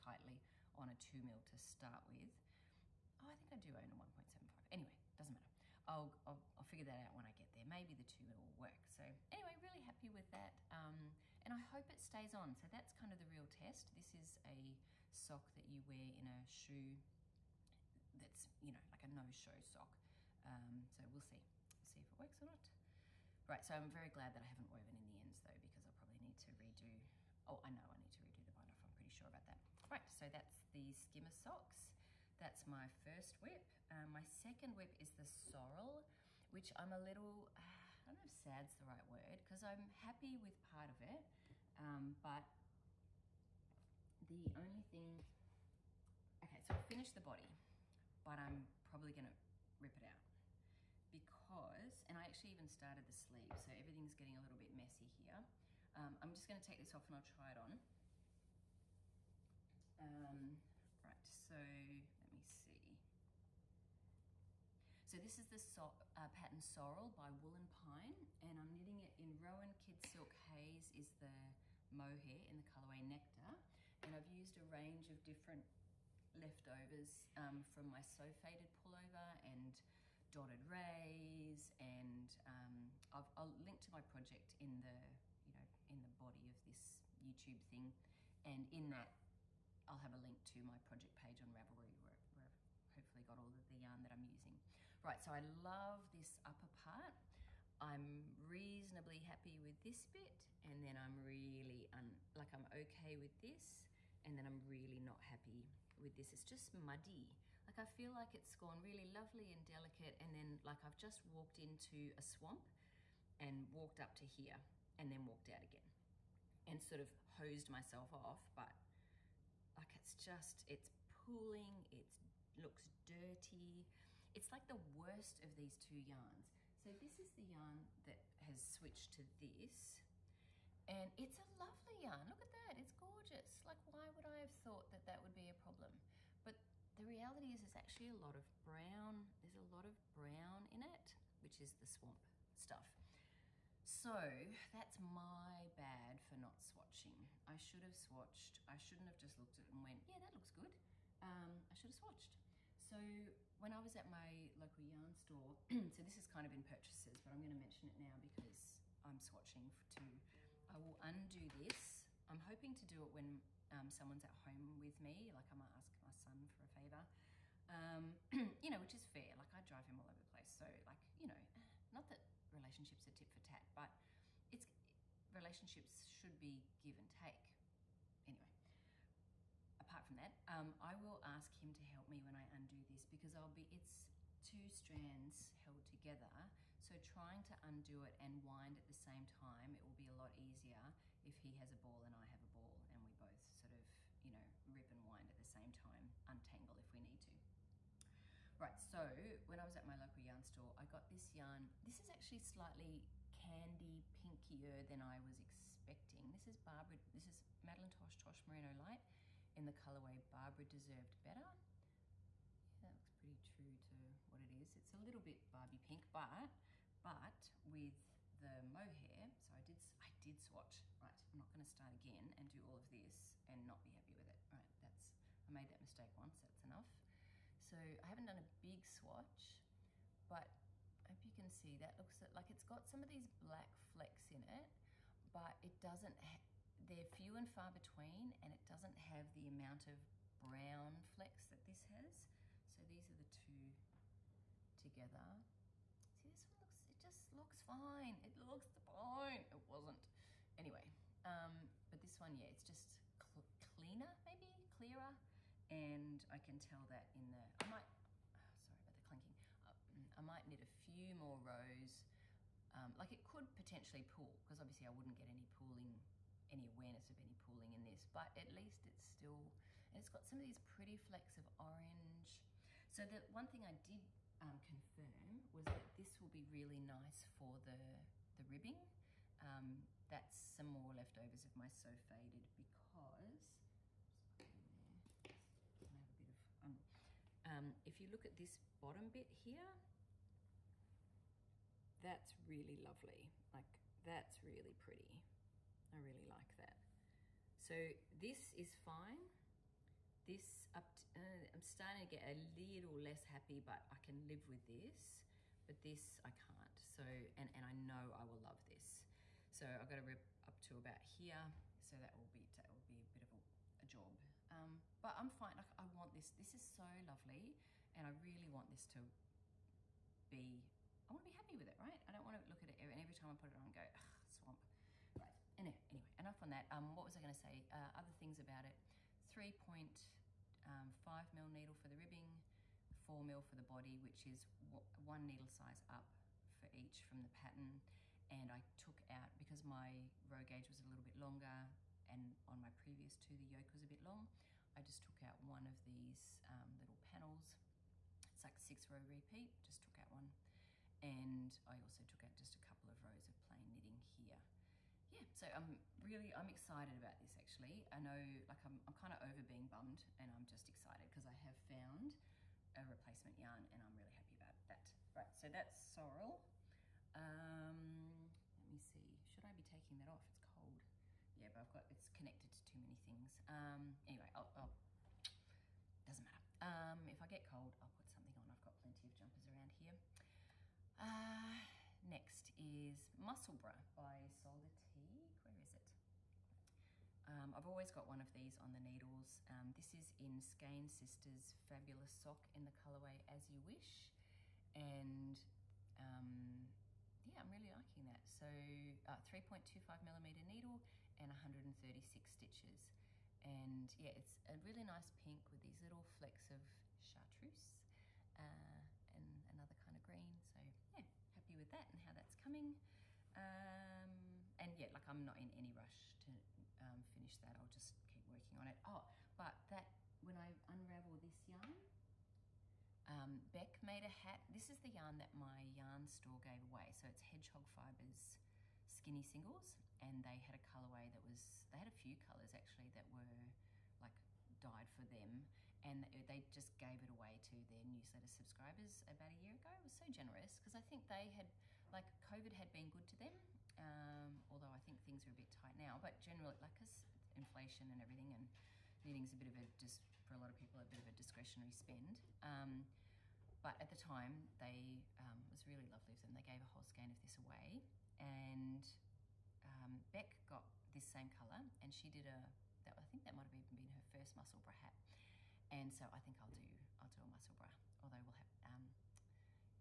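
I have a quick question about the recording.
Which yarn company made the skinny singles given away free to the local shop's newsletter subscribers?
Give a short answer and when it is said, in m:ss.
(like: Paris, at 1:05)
Hedgehog Fibers, at 7:07.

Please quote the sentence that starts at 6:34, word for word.
And um, yeah, I'm really liking that.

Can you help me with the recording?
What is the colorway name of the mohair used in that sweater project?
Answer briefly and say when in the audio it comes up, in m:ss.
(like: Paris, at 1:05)
Nectar, at 1:13.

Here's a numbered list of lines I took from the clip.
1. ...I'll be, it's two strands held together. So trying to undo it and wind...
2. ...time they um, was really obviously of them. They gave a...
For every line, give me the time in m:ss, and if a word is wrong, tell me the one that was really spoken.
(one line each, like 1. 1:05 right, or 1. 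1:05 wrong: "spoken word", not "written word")
1. 3:03 right
2. 7:33 wrong: "lovely", not "obviously".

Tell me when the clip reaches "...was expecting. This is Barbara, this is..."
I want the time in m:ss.
3:25.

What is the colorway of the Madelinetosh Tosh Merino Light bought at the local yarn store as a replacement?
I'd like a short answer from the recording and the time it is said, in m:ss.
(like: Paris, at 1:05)
Barbara Deserved Better, at 3:30.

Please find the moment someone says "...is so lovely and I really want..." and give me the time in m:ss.
5:16.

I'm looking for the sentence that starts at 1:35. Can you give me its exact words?
Right, so I love this upper part.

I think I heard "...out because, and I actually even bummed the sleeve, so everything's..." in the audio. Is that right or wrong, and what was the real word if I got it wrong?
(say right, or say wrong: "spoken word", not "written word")
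wrong: "started", not "bummed".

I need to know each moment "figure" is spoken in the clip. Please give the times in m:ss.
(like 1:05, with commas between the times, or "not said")
0:06.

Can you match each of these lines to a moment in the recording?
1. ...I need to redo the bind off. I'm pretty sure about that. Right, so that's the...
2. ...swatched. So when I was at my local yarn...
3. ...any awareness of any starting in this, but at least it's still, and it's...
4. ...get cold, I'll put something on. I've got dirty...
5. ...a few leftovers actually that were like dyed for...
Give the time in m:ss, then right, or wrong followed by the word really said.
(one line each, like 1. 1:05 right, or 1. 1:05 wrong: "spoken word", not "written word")
1. 0:27 right
2. 2:31 right
3. 4:26 wrong: "pooling", not "starting"
4. 6:17 wrong: "plenty", not "dirty"
5. 7:11 wrong: "colors", not "leftovers".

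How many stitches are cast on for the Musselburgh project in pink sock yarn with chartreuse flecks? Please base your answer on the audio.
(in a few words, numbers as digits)
136.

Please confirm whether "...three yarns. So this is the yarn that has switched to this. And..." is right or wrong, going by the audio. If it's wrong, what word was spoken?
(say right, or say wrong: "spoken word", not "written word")
wrong: "two", not "three".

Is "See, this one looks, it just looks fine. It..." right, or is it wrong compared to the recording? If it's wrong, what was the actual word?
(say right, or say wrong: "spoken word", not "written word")
right.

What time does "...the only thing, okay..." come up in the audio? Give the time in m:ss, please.
0:44.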